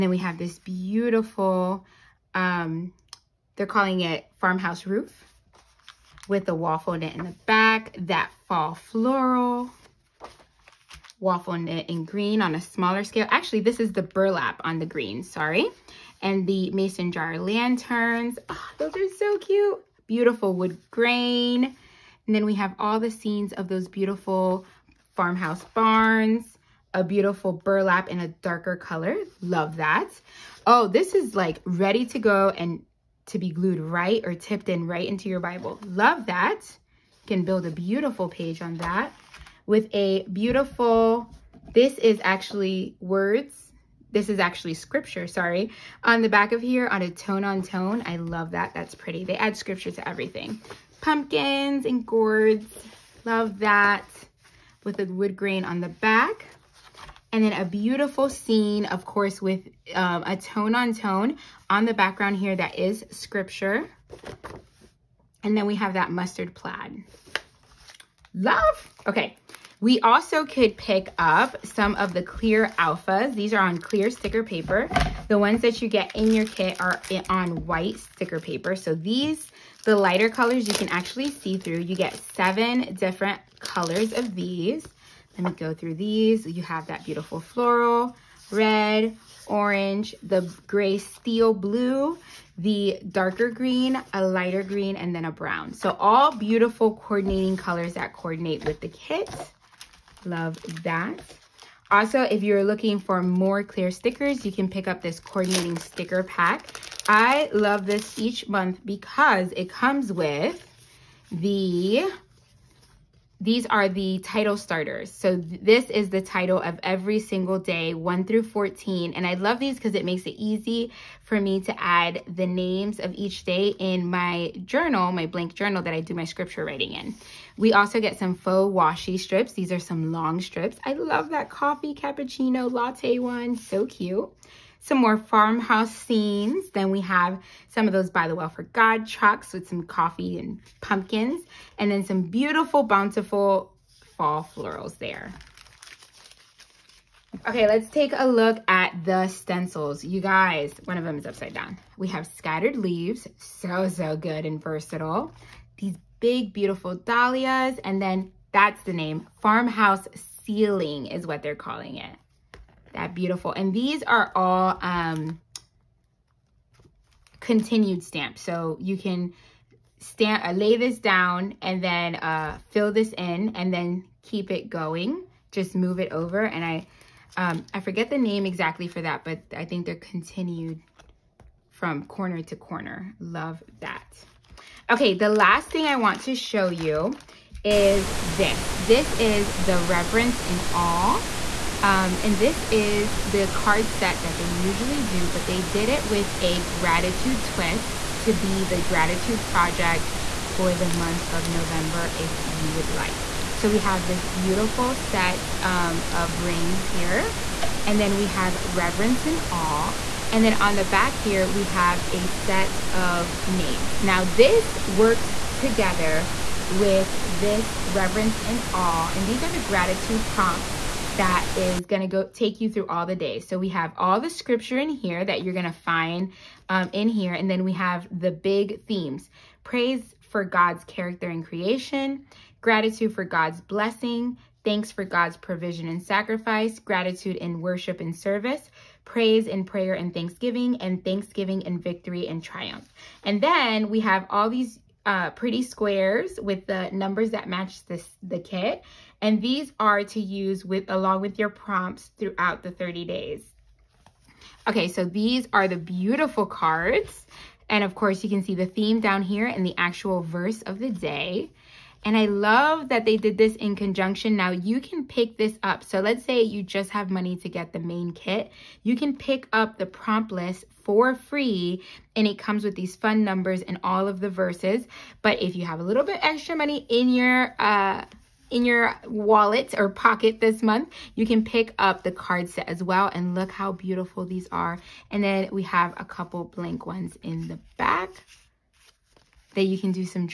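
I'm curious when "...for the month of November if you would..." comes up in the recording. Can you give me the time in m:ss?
3:20.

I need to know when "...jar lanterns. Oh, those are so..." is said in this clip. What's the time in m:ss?
0:17.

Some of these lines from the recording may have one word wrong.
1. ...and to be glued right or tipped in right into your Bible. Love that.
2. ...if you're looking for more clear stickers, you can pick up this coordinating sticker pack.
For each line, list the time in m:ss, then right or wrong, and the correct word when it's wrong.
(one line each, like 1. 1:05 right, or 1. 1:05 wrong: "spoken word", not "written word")
1. 0:32 right
2. 1:42 right.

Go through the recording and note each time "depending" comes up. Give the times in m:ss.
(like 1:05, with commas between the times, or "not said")
not said.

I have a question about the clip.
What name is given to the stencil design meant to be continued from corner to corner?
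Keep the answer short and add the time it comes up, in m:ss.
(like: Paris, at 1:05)
farmhouse ceiling, at 2:39.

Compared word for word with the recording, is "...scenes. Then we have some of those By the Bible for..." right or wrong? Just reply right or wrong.
wrong.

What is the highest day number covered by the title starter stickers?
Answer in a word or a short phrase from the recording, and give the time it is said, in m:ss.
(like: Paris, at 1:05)
14, at 1:58.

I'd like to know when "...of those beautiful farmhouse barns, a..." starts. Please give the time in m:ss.
0:23.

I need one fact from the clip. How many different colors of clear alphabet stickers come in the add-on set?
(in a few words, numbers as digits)
7.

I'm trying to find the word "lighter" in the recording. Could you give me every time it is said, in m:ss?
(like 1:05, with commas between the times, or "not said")
1:19, 1:34.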